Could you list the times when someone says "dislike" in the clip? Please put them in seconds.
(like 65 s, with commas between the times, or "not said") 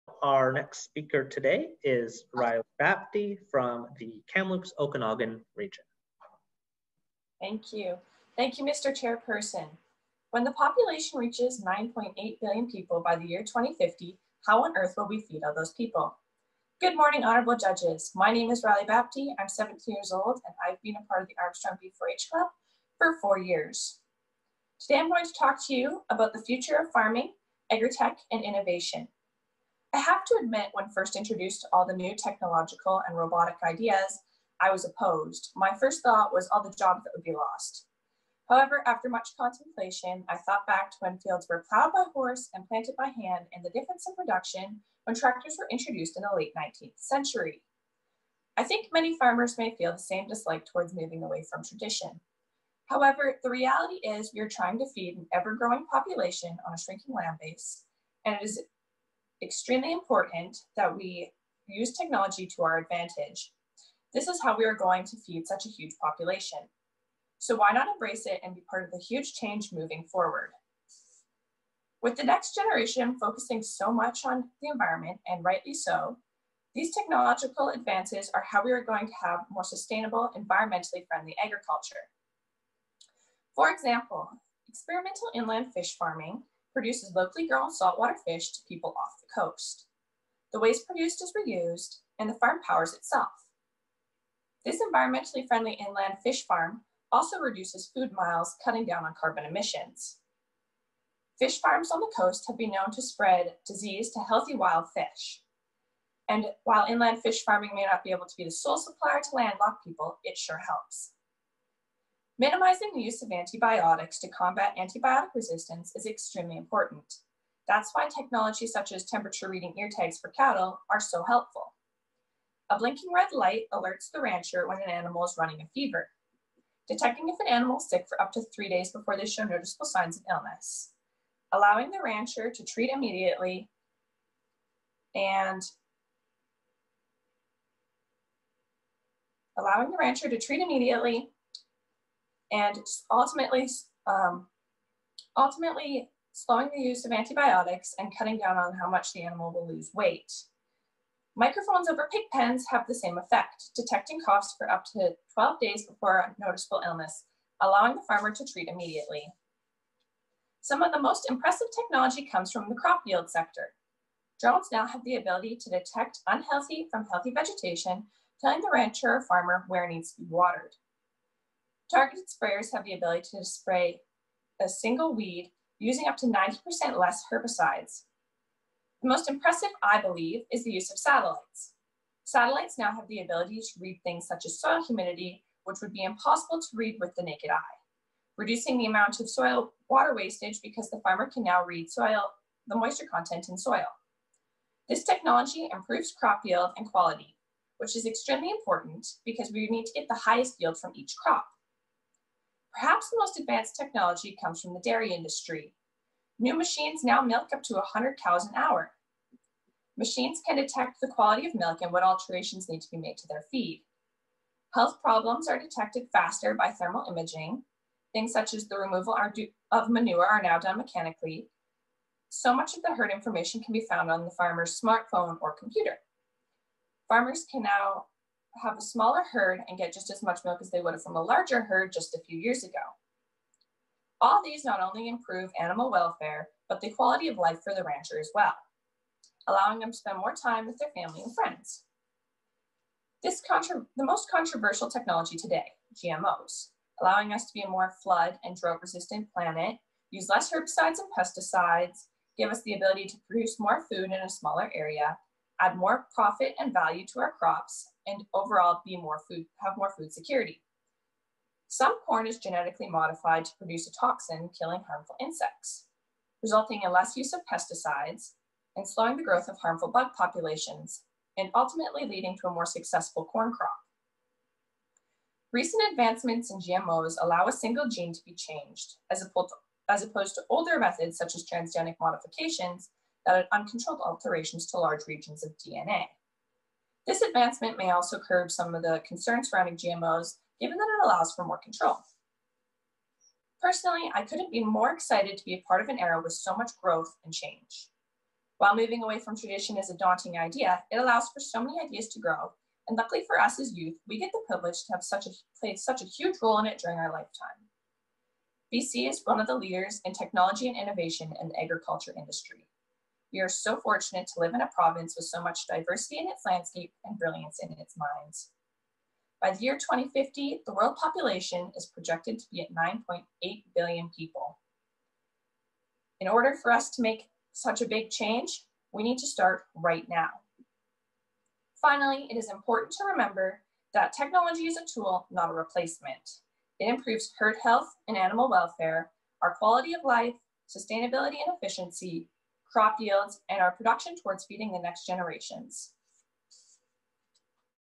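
50 s.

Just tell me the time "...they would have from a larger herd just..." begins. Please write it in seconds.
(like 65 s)
230 s.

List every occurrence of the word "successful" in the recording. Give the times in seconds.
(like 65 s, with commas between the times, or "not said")
272 s.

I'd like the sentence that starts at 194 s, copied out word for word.
This technology improves crop yield and quality, which is extremely important because we need to get the highest yield from each crop.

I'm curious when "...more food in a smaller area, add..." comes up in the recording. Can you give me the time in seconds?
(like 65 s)
253 s.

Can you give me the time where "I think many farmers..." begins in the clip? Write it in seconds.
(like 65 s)
48 s.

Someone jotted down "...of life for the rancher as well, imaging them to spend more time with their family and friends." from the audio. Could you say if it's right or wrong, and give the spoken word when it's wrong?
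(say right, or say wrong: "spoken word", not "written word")
wrong: "allowing", not "imaging".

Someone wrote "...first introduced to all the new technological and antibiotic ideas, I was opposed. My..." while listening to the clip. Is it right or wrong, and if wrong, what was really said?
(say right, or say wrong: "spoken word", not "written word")
wrong: "robotic", not "antibiotic".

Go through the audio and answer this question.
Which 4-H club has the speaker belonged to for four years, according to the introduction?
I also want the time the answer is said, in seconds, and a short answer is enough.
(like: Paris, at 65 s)
Armstrong B4H Club, at 21 s.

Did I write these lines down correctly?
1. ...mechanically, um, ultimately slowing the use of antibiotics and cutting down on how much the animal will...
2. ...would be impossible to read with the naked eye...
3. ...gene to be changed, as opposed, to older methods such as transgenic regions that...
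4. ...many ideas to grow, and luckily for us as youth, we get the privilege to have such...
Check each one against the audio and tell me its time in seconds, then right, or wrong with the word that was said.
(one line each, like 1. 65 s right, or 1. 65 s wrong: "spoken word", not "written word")
1. 143 s wrong: "ultimately", not "mechanically"
2. 185 s right
3. 277 s wrong: "modifications", not "regions"
4. 301 s right.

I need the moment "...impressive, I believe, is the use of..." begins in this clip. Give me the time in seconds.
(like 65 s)
179 s.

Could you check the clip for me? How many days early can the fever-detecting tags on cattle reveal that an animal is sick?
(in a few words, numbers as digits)
3 days.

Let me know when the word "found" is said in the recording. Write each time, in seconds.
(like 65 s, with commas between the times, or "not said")
223 s.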